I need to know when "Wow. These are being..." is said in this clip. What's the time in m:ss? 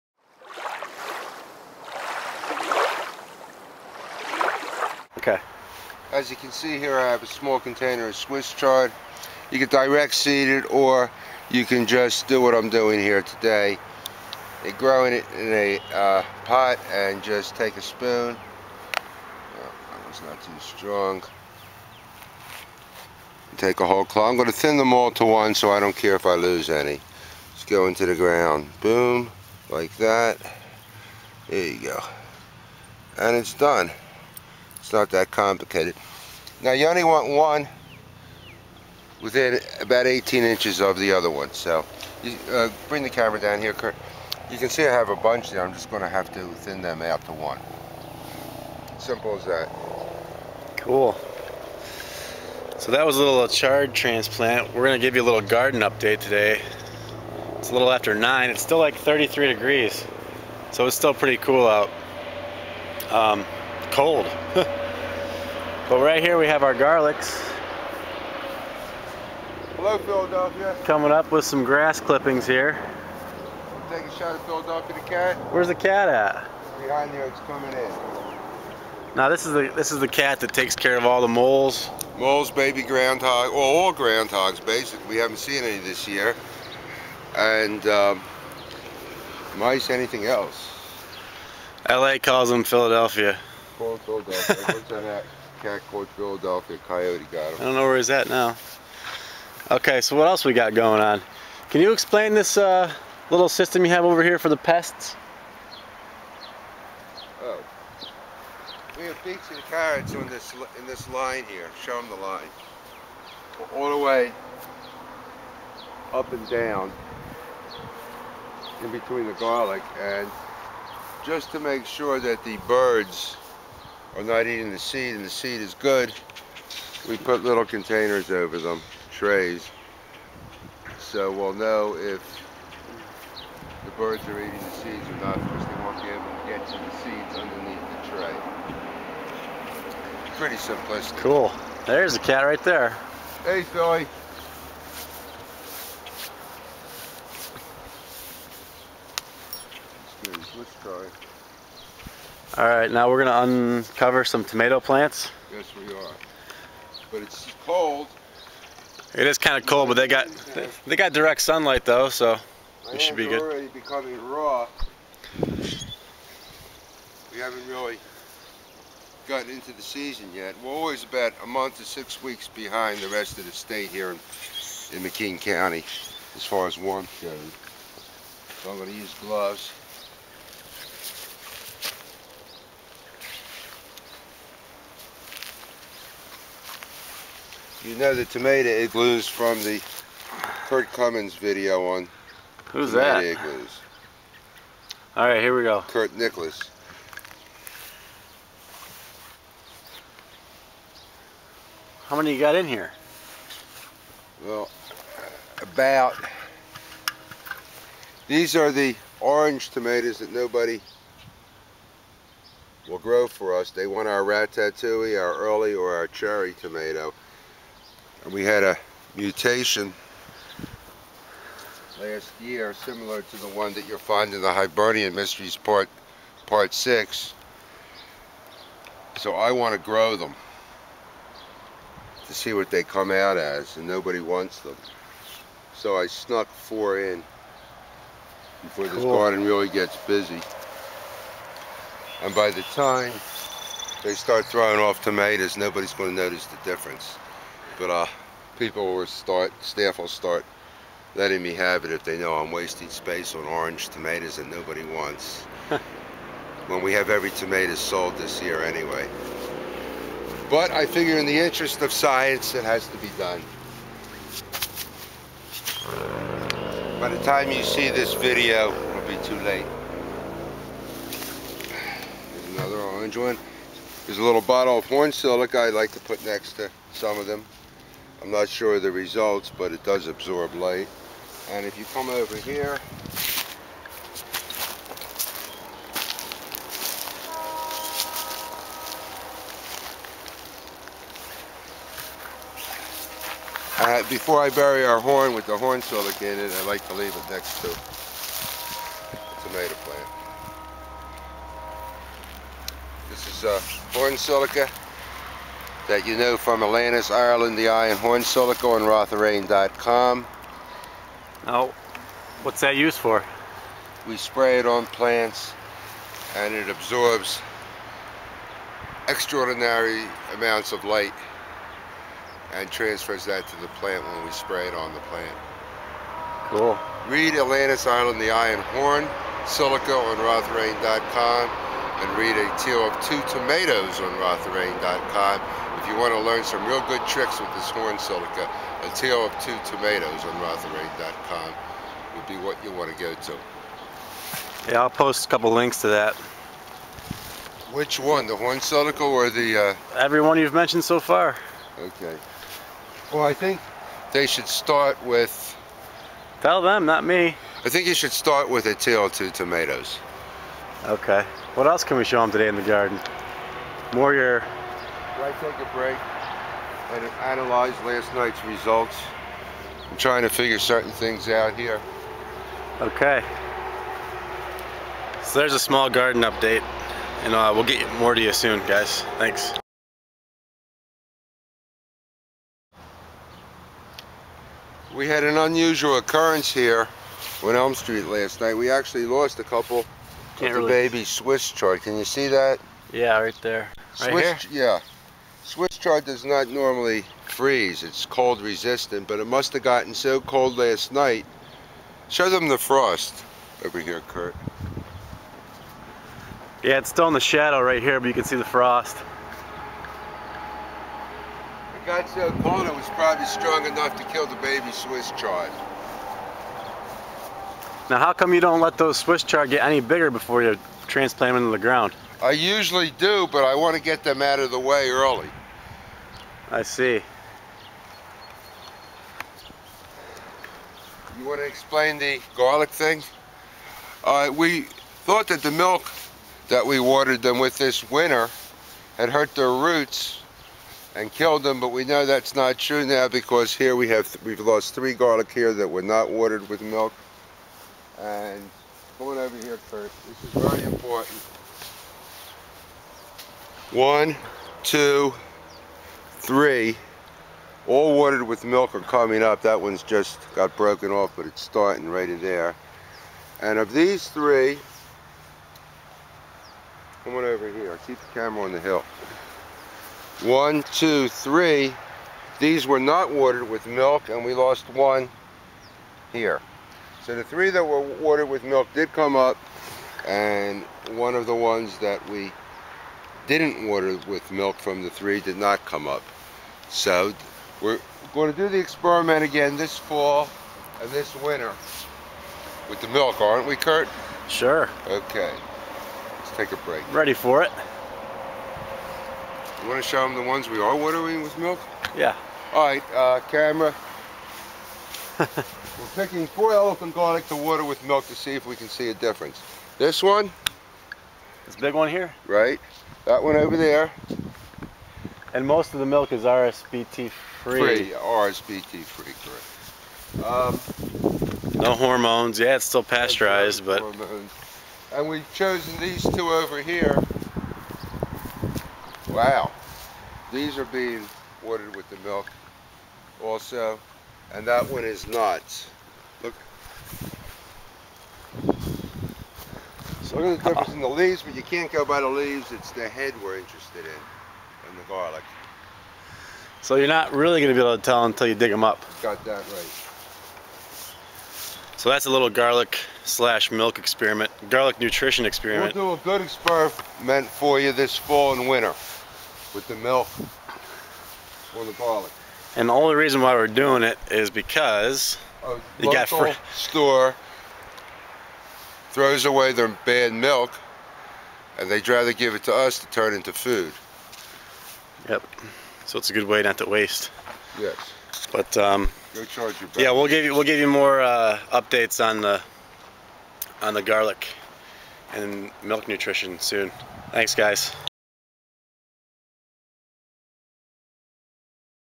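8:49.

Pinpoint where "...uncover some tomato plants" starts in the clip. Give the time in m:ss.
2:33.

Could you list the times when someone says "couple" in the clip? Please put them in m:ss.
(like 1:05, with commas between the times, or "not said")
5:45, 6:29.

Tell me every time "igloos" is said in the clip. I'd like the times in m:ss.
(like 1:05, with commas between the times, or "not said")
3:08, 3:13.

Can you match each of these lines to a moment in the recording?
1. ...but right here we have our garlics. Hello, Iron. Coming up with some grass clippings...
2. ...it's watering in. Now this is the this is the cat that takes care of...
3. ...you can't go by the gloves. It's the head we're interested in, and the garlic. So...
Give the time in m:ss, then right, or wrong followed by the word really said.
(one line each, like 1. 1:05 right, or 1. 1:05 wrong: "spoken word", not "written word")
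1. 1:04 wrong: "Philadelphia", not "Iron"
2. 1:17 wrong: "coming", not "watering"
3. 9:01 wrong: "leaves", not "gloves".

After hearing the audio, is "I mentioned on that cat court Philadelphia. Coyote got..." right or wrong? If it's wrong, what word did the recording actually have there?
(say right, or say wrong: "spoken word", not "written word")
wrong: "worked", not "mentioned".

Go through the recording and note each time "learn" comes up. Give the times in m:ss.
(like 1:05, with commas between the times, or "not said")
5:36.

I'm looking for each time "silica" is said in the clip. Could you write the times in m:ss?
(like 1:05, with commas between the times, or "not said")
4:35, 4:55, 5:04, 5:08, 5:29, 5:37, 5:48.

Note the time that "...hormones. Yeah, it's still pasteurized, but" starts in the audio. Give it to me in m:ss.
8:41.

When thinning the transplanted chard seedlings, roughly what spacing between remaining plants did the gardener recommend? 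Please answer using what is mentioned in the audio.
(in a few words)
18 inches.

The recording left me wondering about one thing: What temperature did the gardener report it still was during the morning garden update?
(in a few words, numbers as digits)
33 degrees.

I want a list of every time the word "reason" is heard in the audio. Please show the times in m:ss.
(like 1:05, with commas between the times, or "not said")
9:22.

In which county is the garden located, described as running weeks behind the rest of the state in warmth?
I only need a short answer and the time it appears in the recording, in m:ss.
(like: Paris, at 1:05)
McKean County, at 2:55.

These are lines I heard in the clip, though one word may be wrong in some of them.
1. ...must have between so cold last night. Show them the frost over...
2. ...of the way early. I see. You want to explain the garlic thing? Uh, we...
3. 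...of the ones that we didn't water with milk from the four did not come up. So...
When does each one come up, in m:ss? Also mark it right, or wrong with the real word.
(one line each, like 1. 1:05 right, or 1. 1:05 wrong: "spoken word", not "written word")
1. 6:39 wrong: "gotten", not "between"
2. 7:04 right
3. 8:01 wrong: "three", not "four".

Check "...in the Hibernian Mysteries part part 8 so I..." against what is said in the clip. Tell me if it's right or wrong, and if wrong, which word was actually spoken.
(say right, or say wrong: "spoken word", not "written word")
wrong: "6", not "8".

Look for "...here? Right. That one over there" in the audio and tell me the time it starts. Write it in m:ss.
8:31.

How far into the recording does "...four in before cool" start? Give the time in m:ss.
3:56.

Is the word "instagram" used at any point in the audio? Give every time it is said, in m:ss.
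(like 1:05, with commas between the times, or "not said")
not said.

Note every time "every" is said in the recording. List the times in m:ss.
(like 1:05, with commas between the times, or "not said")
4:17, 5:49.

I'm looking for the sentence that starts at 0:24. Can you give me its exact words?
I'm going to thin them all to one so I don't care if I lose any.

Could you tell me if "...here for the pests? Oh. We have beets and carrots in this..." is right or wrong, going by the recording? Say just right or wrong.
right.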